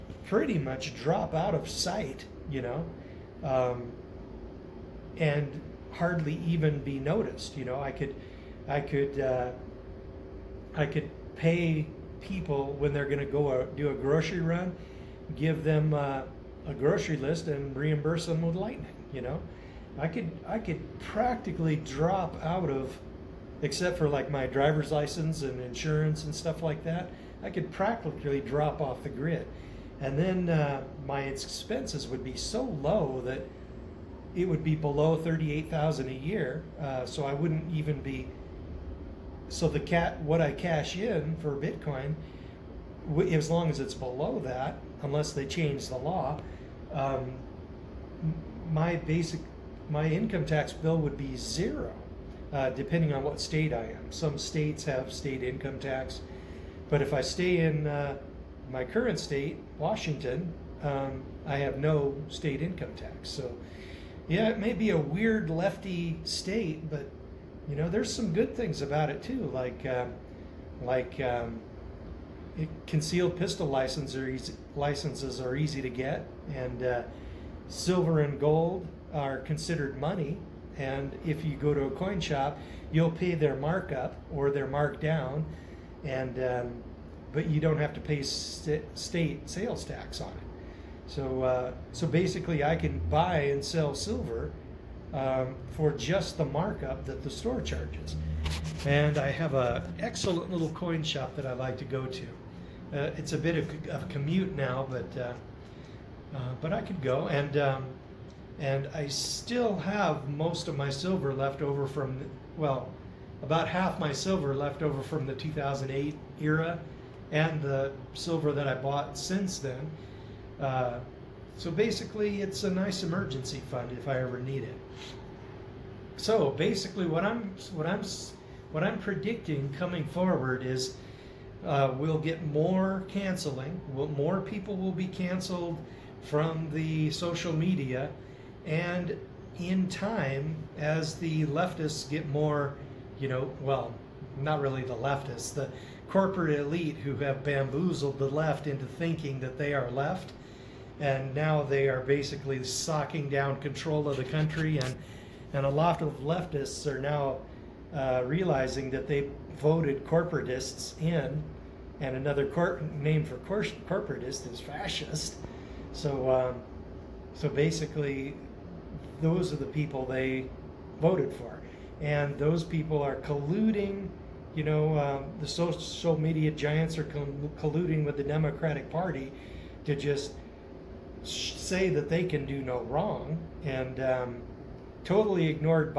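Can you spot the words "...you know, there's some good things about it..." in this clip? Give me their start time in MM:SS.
01:07.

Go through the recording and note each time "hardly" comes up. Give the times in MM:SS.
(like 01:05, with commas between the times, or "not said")
00:05.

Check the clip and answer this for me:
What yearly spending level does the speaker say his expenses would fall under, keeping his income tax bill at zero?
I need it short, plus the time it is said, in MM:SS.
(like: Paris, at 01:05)
38,000, at 00:35.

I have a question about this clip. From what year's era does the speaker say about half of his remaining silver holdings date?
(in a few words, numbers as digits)
2008.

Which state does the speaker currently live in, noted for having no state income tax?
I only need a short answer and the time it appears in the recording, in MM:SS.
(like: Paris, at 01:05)
Washington, at 00:59.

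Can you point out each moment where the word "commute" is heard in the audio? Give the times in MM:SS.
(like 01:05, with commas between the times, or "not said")
01:44.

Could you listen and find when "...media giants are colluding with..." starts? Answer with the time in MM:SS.
02:56.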